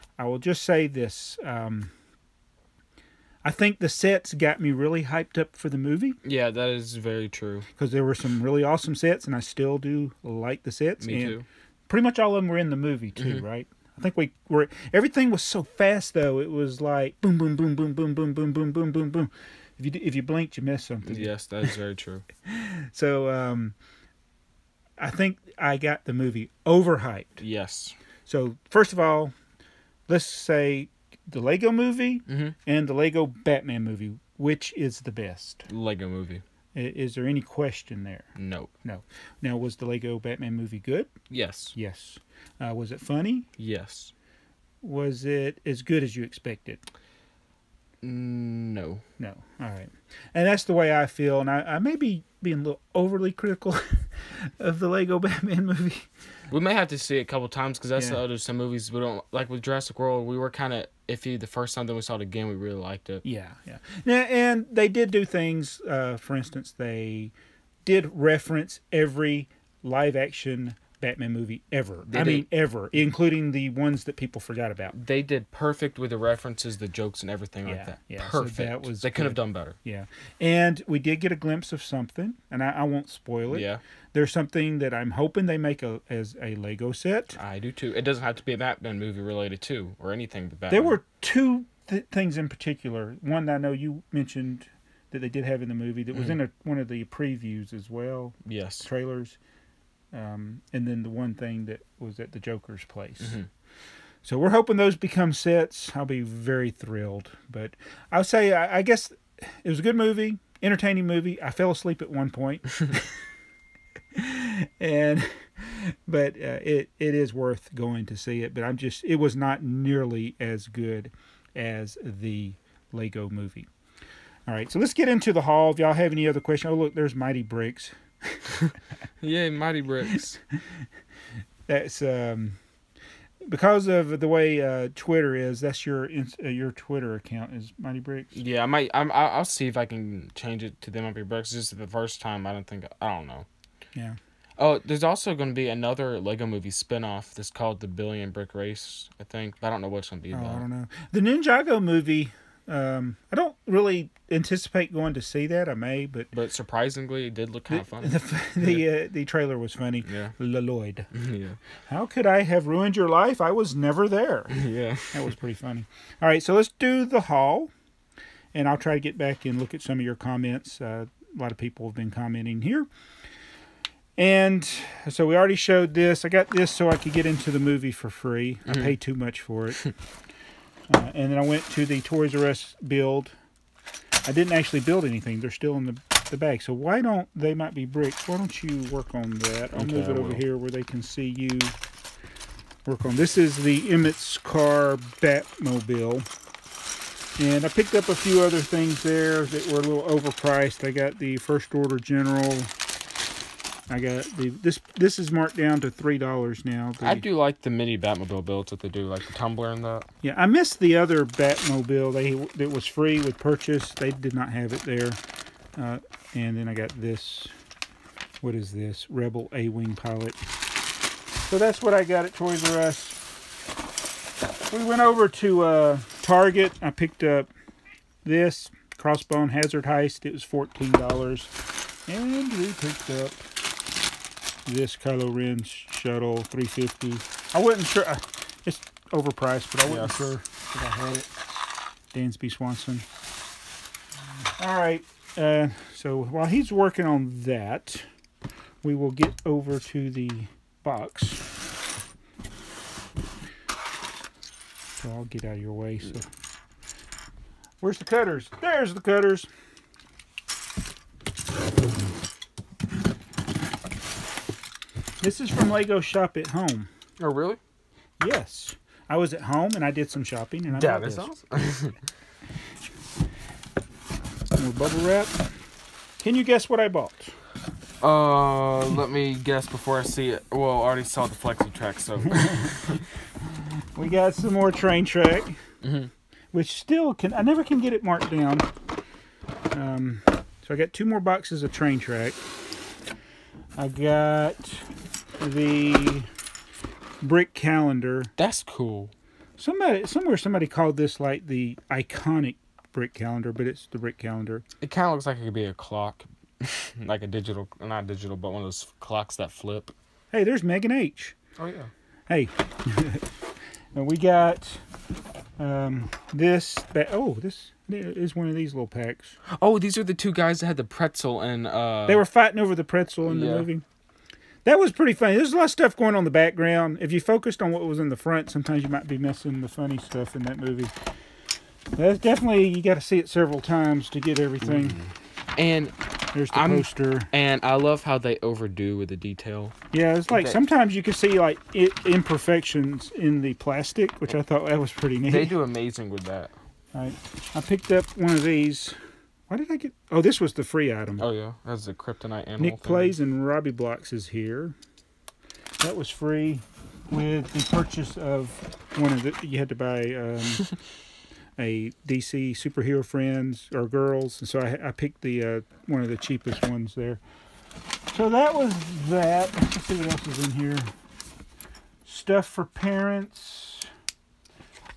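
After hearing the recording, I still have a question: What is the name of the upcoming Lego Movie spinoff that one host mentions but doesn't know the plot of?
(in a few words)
The Billion Brick Race.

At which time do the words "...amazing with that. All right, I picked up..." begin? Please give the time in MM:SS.
05:45.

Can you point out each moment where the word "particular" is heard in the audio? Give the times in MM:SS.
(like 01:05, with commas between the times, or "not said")
01:32.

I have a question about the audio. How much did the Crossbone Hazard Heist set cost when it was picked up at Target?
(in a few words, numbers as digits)
$14.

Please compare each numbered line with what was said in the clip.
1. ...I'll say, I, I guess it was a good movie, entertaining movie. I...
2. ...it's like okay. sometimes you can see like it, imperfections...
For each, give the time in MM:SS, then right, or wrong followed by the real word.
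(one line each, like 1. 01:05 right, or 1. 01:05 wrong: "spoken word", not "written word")
1. 01:48 right
2. 05:40 right.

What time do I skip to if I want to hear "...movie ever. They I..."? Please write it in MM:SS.
01:11.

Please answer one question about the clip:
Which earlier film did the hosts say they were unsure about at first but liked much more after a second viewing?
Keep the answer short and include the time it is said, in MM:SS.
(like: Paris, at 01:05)
Jurassic World, at 00:59.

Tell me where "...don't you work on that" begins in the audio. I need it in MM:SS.
03:08.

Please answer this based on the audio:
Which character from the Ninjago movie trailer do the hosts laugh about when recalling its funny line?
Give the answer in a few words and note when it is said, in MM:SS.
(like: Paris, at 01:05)
Lloyd, at 02:40.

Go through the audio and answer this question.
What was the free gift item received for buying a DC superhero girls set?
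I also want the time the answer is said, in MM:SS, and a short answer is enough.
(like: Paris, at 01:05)
The kryptonite animal, at 05:51.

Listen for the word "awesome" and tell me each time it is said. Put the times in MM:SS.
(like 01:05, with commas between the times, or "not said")
00:08, 04:31.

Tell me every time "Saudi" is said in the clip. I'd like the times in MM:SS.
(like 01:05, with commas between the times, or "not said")
not said.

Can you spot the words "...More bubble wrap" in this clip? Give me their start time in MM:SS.
04:34.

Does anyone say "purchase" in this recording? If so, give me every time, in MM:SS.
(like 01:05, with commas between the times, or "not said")
03:33, 05:57.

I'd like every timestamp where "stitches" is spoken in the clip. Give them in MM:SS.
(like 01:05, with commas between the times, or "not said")
not said.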